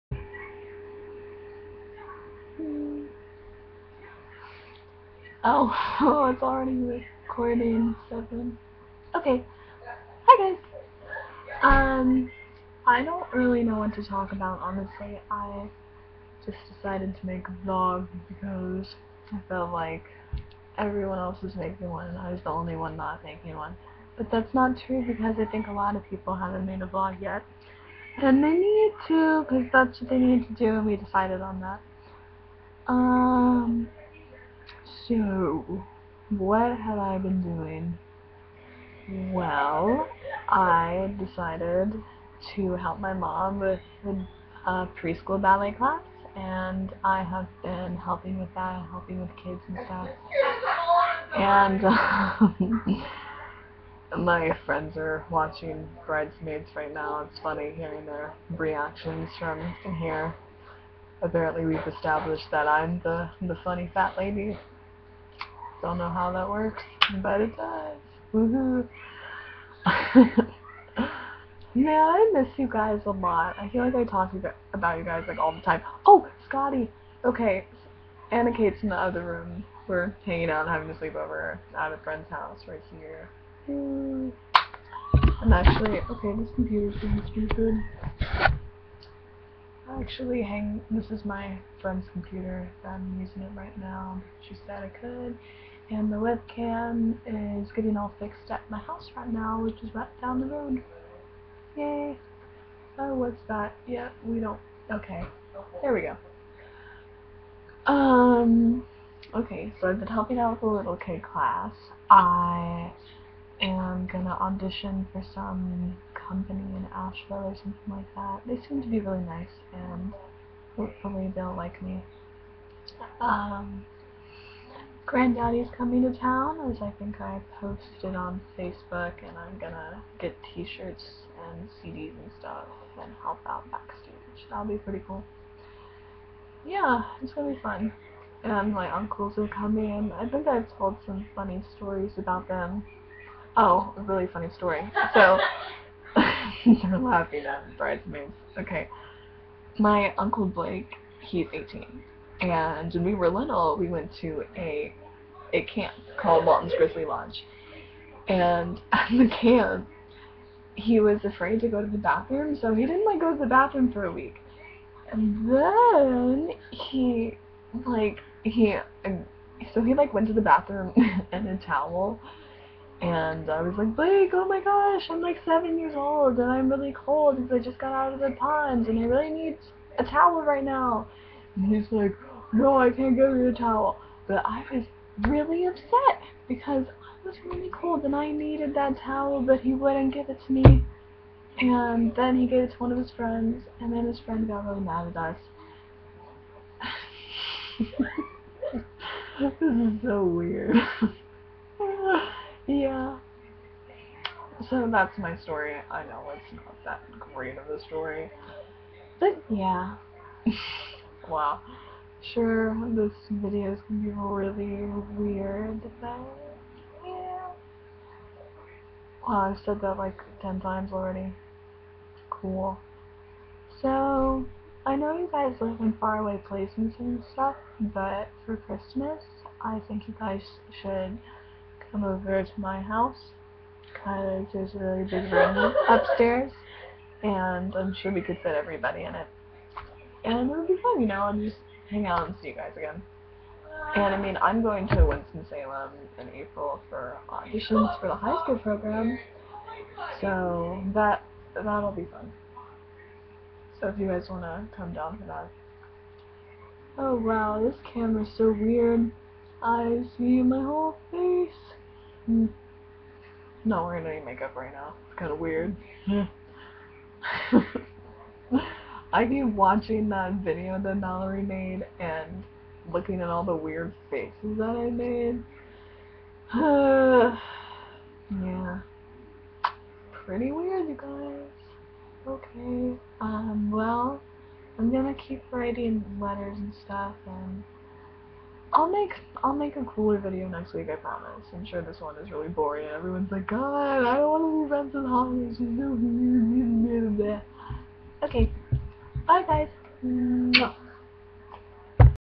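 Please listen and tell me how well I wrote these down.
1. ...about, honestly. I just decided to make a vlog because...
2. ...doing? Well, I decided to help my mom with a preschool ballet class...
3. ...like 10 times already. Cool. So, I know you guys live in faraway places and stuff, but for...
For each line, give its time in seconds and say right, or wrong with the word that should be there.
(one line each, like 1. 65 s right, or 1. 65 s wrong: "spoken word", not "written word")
1. 14 s right
2. 37 s right
3. 219 s right.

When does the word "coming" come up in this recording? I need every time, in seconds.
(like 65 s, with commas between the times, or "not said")
125 s, 139 s.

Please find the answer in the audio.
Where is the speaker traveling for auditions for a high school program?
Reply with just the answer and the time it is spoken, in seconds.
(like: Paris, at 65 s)
Winston-Salem, at 245 s.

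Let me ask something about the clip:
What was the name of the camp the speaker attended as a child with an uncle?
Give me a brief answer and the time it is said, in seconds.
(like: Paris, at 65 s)
Walton's Grizzly Lodge, at 156 s.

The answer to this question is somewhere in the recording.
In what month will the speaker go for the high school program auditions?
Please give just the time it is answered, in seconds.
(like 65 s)
246 s.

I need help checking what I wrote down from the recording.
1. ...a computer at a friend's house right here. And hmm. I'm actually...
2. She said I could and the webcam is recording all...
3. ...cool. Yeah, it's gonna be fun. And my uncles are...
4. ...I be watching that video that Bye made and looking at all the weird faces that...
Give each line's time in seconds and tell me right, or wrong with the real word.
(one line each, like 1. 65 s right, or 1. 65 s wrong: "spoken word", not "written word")
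1. 80 s wrong: "sleepover", not "computer"
2. 94 s wrong: "getting", not "recording"
3. 135 s right
4. 269 s wrong: "Mallory", not "Bye".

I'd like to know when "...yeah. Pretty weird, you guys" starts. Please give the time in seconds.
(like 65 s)
278 s.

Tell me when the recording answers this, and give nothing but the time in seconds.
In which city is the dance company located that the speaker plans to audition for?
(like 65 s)
116 s.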